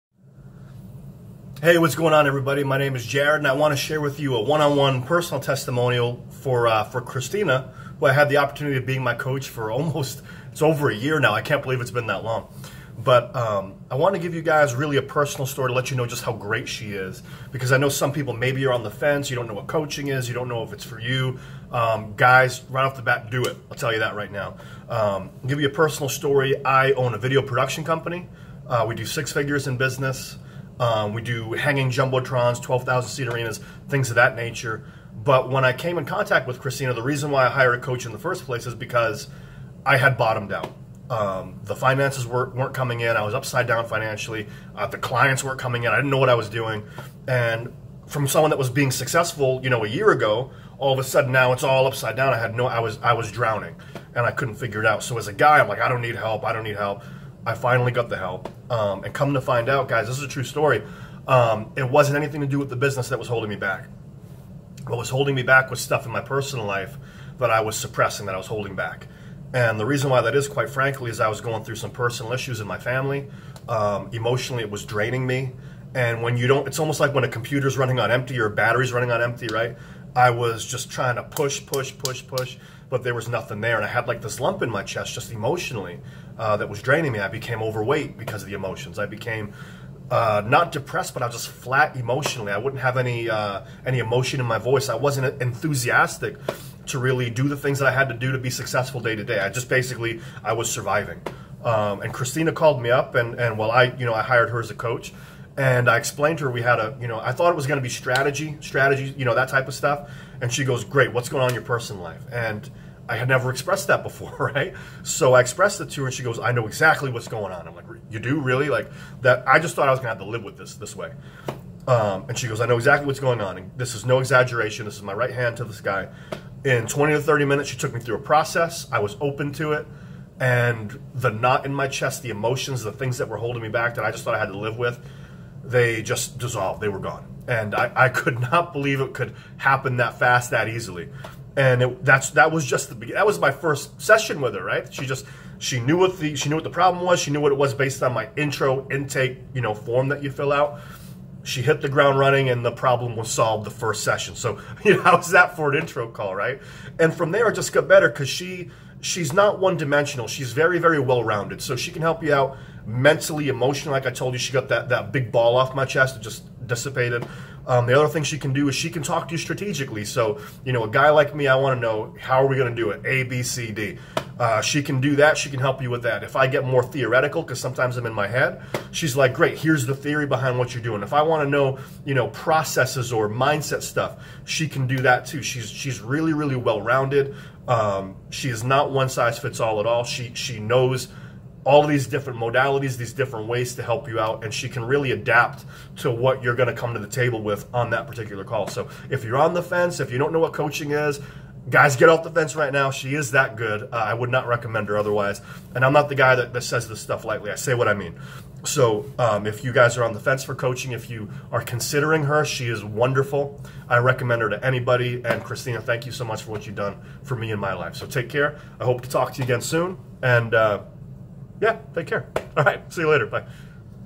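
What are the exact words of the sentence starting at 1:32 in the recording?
I wouldn't have any uh, any emotion in my voice.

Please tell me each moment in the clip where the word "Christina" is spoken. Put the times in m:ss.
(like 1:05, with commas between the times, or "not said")
0:07, 0:36, 1:42, 3:35.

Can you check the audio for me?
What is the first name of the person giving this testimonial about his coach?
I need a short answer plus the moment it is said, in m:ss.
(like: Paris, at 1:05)
Jared, at 0:03.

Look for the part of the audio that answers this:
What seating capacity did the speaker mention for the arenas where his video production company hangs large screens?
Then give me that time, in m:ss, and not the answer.
0:32.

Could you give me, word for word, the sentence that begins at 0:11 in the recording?
I can't believe it's been that long.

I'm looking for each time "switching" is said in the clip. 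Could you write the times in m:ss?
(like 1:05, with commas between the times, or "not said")
not said.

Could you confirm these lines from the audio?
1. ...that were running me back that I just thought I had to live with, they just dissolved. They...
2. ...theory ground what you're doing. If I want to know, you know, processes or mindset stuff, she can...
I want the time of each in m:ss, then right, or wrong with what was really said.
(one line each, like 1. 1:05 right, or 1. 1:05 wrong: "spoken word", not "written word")
1. 2:13 wrong: "holding", not "running"
2. 2:59 wrong: "behind", not "ground".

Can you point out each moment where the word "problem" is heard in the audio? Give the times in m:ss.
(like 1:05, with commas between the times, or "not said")
2:26, 2:32.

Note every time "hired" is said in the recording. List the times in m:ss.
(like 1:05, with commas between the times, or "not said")
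0:37, 1:44.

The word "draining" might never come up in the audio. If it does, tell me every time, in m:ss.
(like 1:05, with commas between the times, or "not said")
1:14, 1:26.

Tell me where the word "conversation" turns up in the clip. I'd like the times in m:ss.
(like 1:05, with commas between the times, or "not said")
not said.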